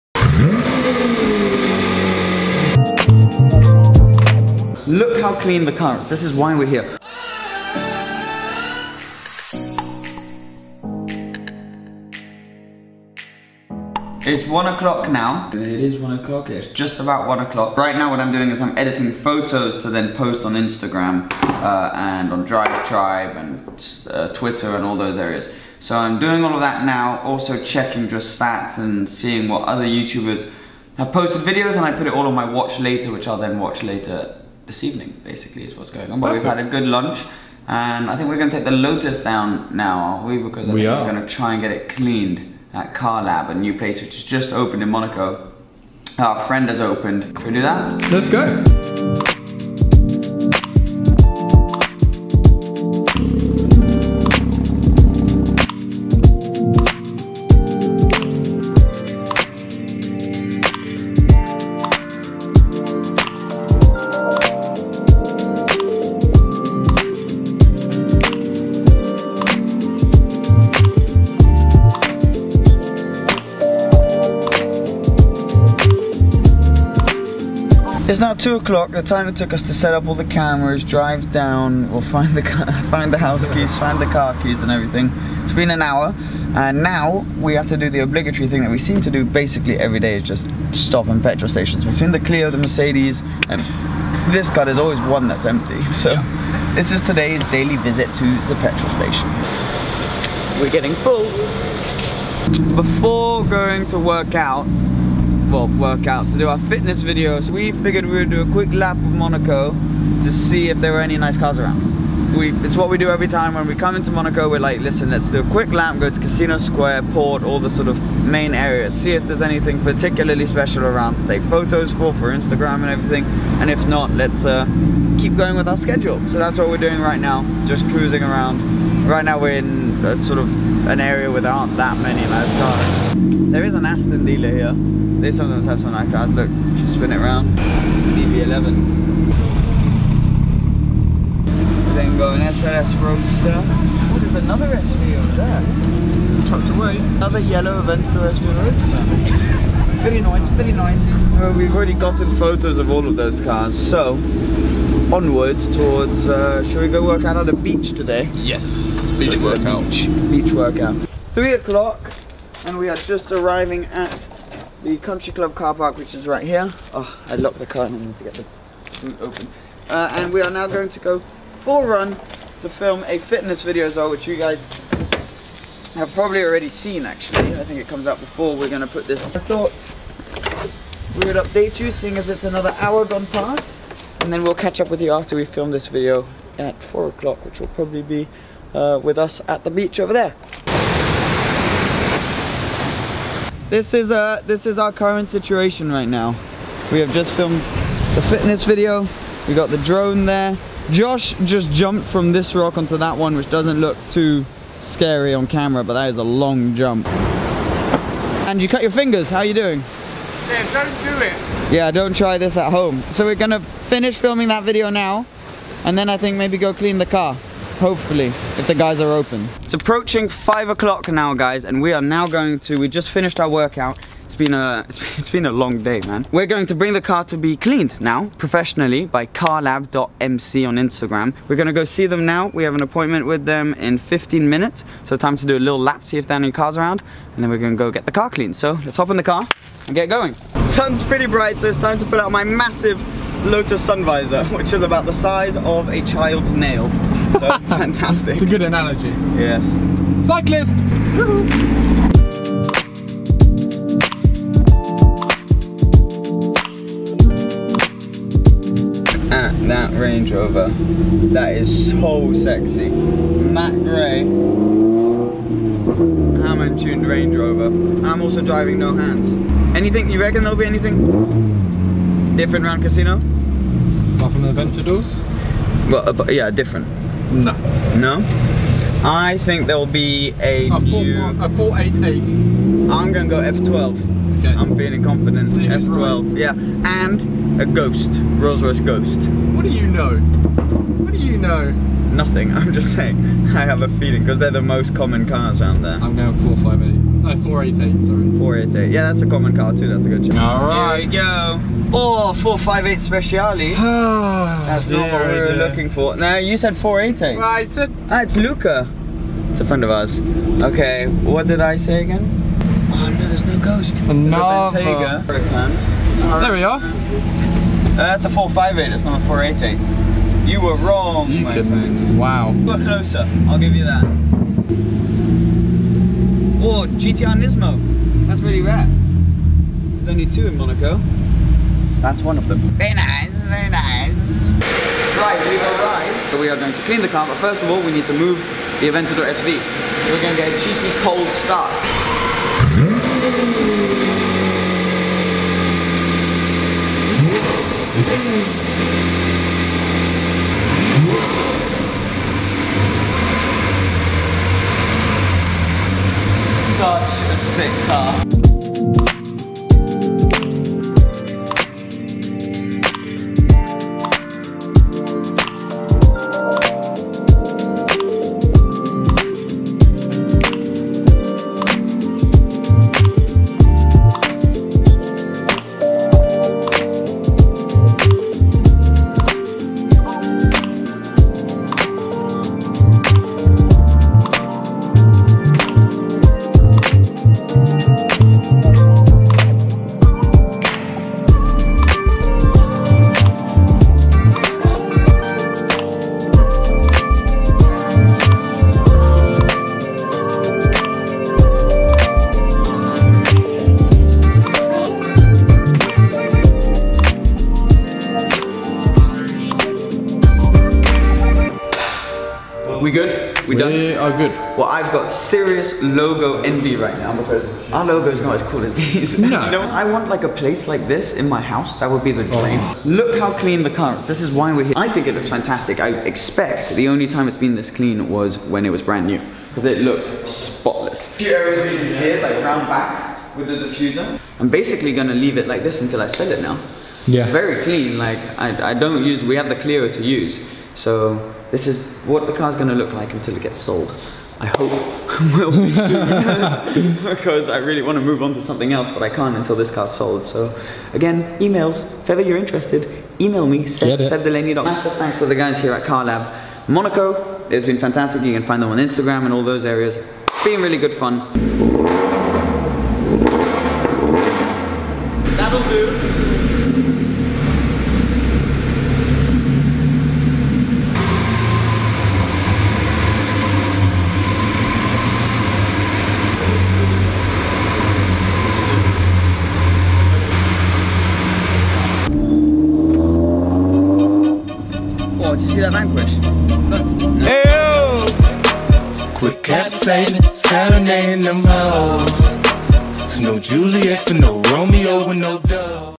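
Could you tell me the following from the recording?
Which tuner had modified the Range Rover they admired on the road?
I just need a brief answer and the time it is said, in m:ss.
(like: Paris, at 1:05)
Hamann, at 4:26.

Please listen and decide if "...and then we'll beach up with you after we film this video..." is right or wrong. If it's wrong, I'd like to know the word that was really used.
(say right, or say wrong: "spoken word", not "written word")
wrong: "catch", not "beach".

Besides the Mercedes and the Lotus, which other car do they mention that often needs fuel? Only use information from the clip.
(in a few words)
Clio.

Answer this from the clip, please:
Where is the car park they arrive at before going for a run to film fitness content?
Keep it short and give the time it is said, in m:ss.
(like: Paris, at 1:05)
country club, at 2:44.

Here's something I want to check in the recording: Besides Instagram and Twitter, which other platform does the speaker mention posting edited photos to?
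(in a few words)
Drive Tribe.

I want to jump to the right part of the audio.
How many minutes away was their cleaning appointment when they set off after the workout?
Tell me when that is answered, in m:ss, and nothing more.
3:53.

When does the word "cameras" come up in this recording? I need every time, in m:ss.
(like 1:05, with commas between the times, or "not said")
1:20, 3:25.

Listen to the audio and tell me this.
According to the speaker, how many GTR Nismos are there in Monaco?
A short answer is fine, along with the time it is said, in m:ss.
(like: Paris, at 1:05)
2, at 5:30.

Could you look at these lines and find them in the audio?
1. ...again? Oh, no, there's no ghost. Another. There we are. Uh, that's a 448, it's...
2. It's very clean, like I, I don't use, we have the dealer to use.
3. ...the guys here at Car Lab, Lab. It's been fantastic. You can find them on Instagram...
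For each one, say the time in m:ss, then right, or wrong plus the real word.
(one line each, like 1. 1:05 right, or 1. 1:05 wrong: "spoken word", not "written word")
1. 5:12 wrong: "458", not "448"
2. 7:17 wrong: "clearer", not "dealer"
3. 7:35 wrong: "Monaco", not "Lab".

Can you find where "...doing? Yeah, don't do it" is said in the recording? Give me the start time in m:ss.
3:29.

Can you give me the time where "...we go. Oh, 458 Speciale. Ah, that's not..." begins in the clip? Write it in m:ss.
5:01.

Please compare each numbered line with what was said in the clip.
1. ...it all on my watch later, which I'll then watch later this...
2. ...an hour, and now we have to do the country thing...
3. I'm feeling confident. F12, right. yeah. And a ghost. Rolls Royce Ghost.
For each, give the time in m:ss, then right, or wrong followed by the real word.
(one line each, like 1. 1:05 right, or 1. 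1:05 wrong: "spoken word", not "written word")
1. 0:32 right
2. 1:25 wrong: "obligatory", not "country"
3. 4:44 right.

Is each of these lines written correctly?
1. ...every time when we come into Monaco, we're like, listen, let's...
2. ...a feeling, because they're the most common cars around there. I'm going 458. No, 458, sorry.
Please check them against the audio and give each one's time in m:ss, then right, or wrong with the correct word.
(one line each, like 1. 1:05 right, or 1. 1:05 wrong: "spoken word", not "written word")
1. 1:53 right
2. 4:53 wrong: "488", not "458".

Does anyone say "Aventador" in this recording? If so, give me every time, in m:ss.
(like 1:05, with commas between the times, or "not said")
2:27, 4:34, 5:38.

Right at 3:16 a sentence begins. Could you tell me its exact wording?
We have just filmed the fitness video.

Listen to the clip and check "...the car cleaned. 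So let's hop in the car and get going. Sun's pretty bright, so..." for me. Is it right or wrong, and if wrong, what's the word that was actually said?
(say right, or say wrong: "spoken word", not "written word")
right.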